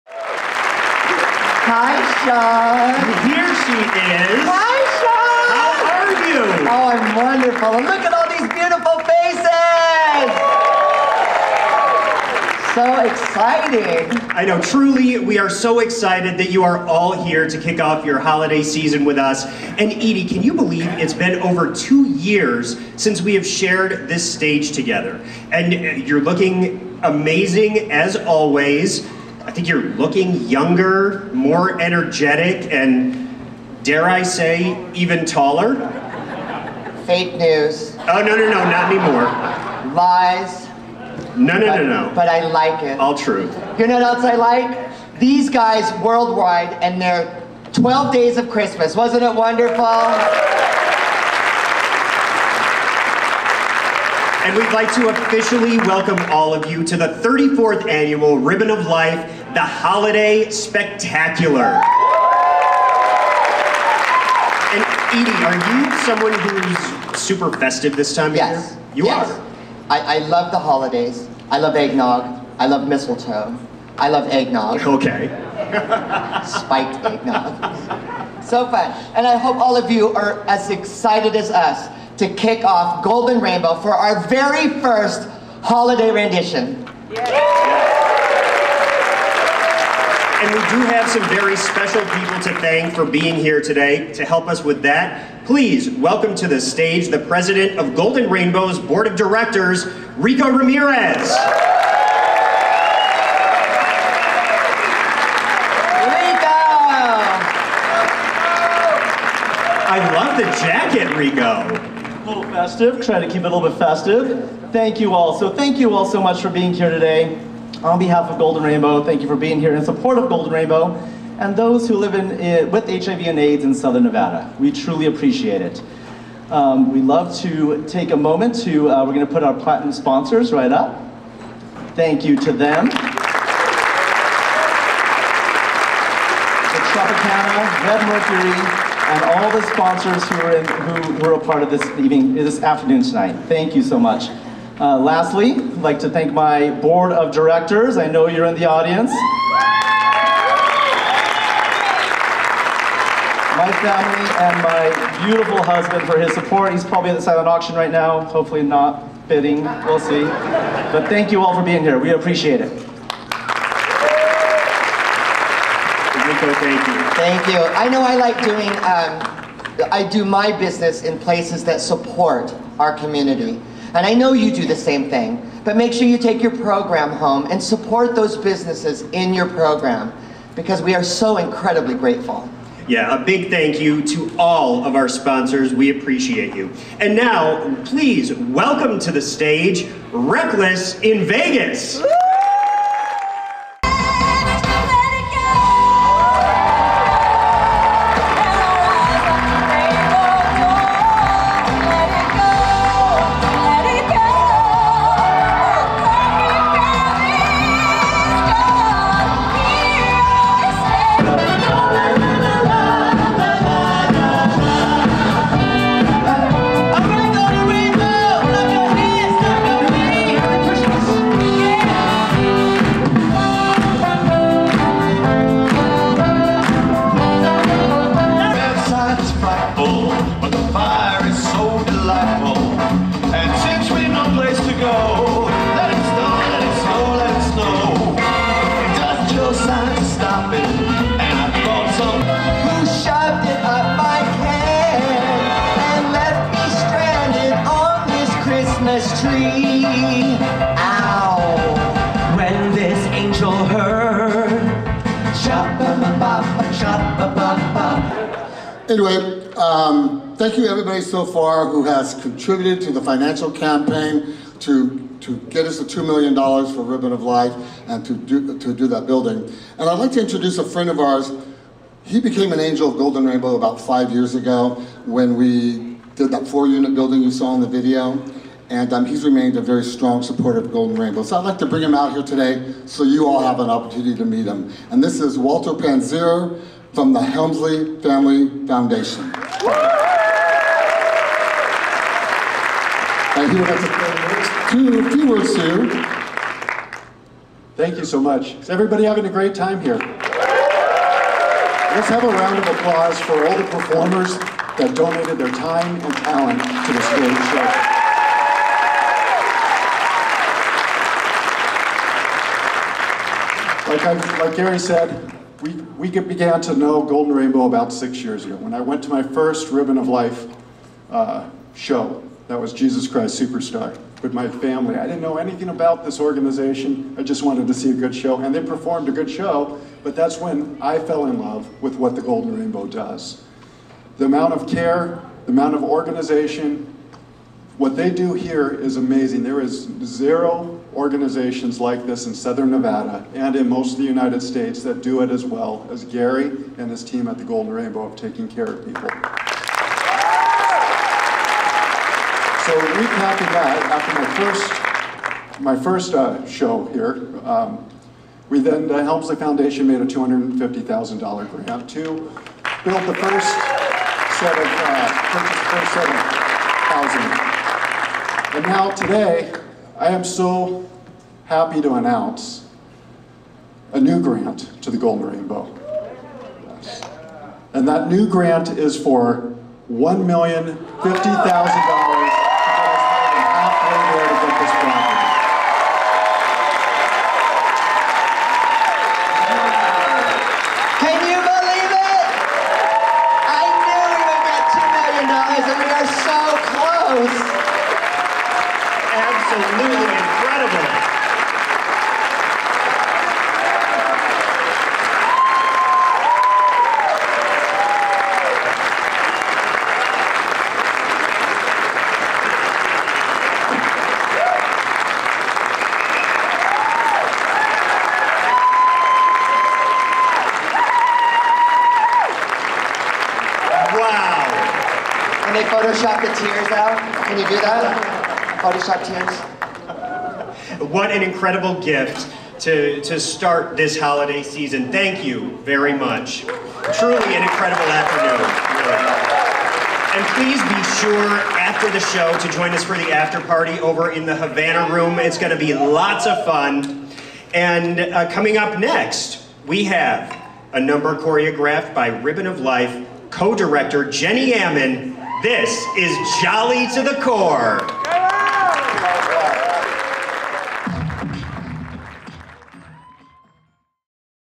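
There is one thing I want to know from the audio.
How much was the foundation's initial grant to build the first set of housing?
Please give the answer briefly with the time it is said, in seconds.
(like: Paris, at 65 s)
$250,000, at 360 s.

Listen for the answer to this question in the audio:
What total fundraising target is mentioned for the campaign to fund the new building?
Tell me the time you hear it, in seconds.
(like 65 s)
265 s.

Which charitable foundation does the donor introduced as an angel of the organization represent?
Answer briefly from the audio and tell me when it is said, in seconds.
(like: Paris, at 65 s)
Helmsley Family Foundation, at 287 s.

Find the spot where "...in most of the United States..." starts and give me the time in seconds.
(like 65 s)
343 s.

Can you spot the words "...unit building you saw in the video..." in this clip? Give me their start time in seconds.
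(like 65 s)
276 s.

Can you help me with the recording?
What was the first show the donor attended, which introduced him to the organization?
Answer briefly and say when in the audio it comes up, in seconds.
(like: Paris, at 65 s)
Jesus Christ Superstar, at 322 s.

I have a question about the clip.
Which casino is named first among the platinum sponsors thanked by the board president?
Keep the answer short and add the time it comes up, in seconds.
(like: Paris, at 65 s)
Tropicana, at 132 s.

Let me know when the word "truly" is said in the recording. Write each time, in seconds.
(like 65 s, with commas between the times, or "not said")
14 s, 124 s, 436 s.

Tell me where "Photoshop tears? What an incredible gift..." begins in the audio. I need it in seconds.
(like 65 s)
428 s.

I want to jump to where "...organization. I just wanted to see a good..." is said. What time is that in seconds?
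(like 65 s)
326 s.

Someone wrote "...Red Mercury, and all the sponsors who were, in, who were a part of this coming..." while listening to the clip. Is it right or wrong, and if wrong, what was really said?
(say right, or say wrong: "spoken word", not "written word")
wrong: "evening", not "coming".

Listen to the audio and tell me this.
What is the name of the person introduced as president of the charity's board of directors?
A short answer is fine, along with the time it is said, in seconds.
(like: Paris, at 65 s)
Rico Ramirez, at 100 s.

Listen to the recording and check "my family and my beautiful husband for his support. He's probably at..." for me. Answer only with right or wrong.
right.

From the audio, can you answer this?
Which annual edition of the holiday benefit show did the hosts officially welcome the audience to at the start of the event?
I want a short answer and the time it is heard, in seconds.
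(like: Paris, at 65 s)
34th, at 57 s.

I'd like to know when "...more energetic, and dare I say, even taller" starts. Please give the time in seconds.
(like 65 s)
31 s.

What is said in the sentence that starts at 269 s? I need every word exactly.
And I'd like to introduce a friend of ours.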